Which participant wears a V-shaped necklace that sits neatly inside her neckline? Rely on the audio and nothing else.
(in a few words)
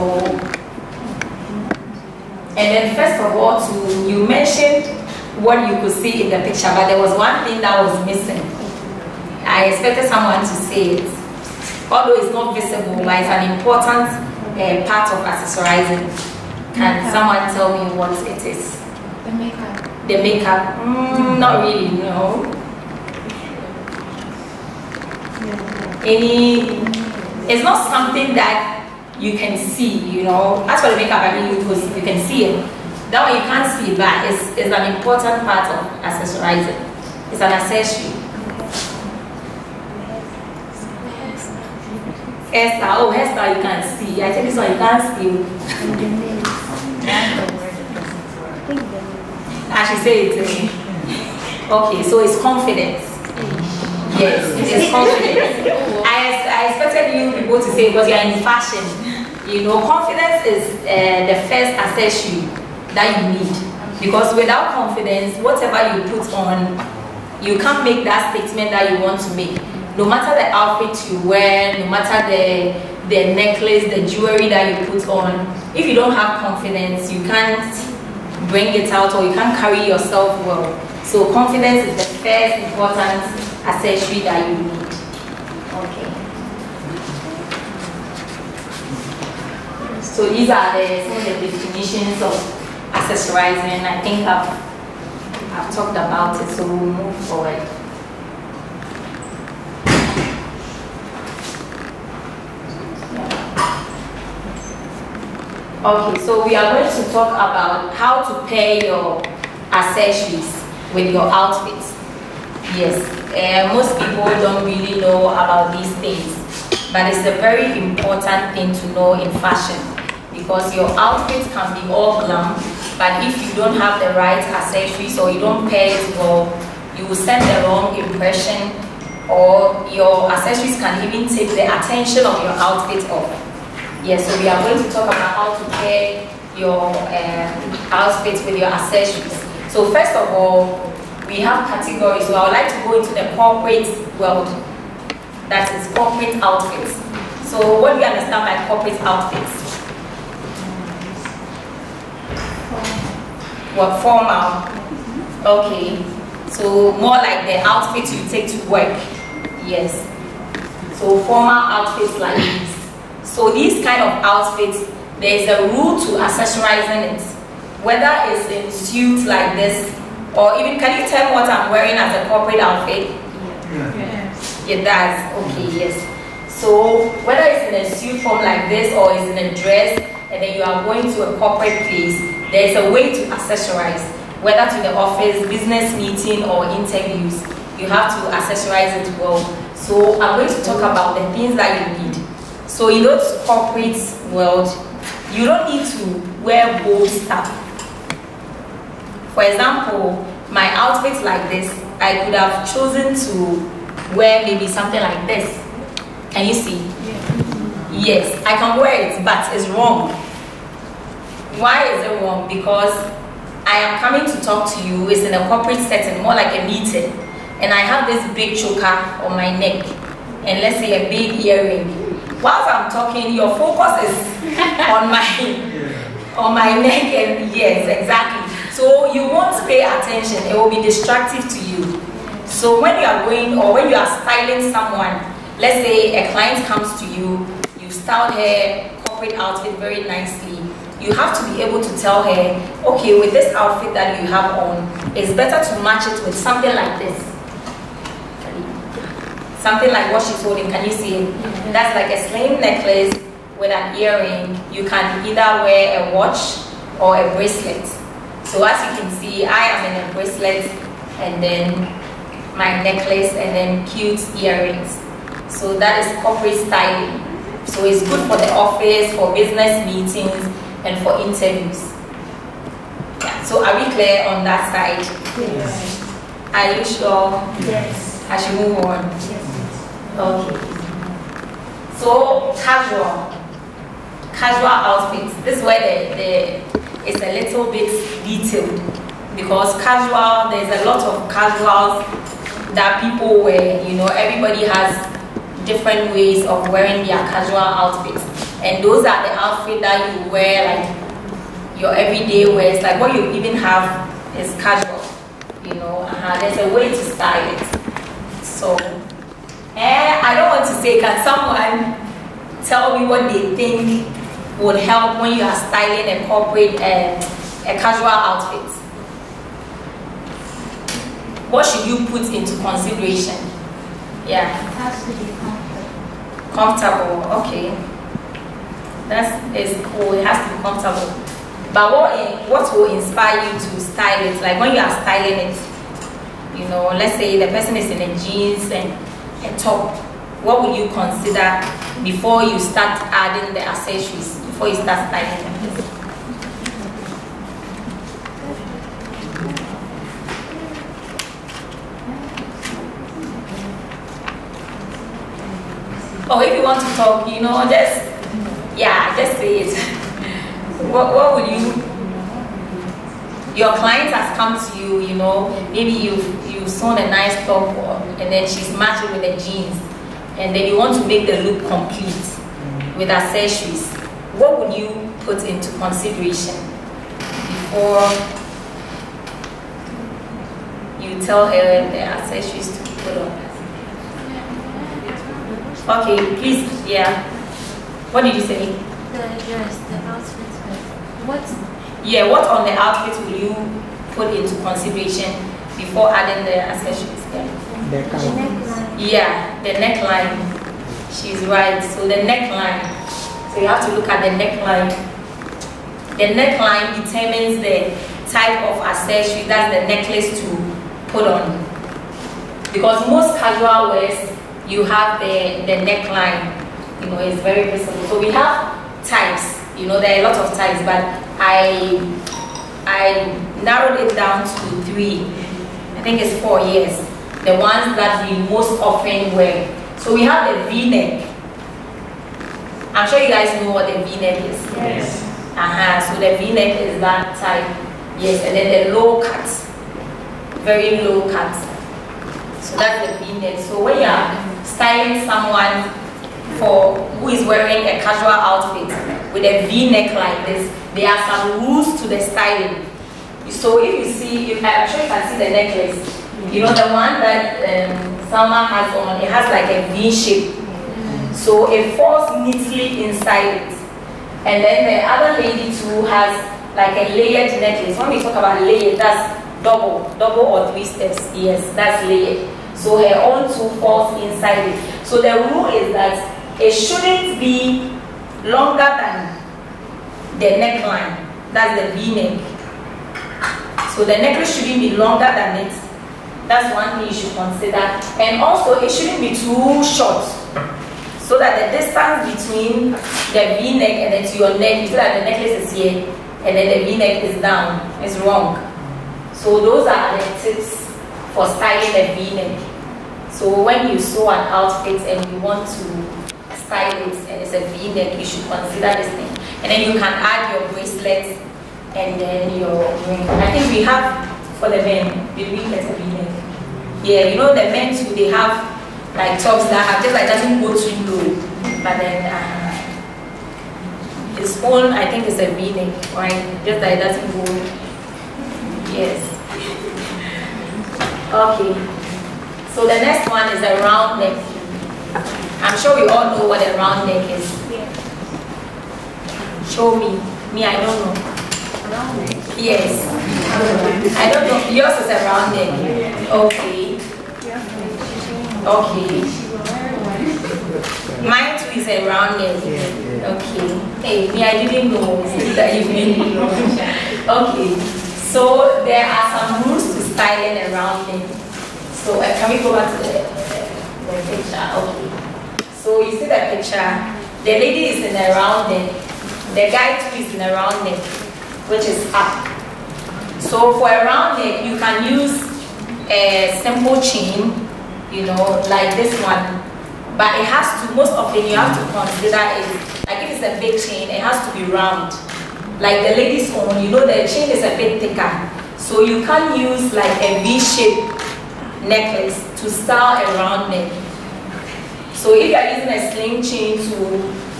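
Salma.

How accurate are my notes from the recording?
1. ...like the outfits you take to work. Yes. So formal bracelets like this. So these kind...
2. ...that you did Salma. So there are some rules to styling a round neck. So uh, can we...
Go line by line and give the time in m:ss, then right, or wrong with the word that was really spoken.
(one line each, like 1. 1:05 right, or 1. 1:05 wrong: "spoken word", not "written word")
1. 2:37 wrong: "outfits", not "bracelets"
2. 9:15 wrong: "Okay", not "Salma".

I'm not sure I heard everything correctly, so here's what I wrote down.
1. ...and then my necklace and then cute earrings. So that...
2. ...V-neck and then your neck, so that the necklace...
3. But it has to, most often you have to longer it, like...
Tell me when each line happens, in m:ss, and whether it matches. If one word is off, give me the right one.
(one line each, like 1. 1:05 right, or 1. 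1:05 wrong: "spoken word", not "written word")
1. 4:21 right
2. 8:13 right
3. 9:40 wrong: "consider", not "longer".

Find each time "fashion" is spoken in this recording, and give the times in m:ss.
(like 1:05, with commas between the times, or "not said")
0:58, 1:59.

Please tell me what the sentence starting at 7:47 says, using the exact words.
When we talk about layered, that's double, double or three steps.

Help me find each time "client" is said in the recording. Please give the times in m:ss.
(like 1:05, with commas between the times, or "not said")
3:56, 6:03.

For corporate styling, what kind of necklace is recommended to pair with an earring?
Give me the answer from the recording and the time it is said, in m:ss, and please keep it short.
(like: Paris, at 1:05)
Slim necklace, at 4:12.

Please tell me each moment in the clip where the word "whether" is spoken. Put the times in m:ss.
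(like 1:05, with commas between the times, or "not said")
2:47, 2:57, 3:04.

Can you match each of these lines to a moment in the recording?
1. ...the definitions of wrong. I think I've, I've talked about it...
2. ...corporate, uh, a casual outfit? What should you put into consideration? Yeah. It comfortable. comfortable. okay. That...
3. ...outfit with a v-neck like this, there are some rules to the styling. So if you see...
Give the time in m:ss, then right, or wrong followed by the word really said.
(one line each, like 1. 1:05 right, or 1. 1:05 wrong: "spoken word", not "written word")
1. 1:31 wrong: "accessorizing", not "wrong"
2. 5:16 right
3. 7:28 right.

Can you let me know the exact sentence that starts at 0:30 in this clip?
That's what the makeup, I mean, you, you can see it.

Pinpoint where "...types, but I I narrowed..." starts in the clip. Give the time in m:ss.
7:00.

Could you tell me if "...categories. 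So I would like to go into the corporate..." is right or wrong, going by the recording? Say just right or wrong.
right.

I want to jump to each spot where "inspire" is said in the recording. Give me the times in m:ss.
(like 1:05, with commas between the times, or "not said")
5:32.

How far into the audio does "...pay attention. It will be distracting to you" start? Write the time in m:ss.
3:49.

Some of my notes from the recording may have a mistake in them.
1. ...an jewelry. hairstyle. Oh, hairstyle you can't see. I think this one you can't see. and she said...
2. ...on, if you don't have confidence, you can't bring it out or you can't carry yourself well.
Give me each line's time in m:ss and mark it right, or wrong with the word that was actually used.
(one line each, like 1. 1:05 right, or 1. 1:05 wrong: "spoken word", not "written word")
1. 0:37 wrong: "accessory", not "jewelry"
2. 1:15 right.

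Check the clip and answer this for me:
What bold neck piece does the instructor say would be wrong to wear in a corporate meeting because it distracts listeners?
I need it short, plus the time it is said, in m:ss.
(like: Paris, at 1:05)
Big choker, at 3:38.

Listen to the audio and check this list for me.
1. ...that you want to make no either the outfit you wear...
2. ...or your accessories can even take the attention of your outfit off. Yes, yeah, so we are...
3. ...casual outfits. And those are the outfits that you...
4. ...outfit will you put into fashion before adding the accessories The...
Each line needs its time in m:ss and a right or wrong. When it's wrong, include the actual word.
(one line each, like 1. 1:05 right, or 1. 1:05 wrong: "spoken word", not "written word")
1. 1:08 wrong: "matter", not "either"
2. 2:09 right
3. 4:57 right
4. 6:32 wrong: "consideration", not "fashion".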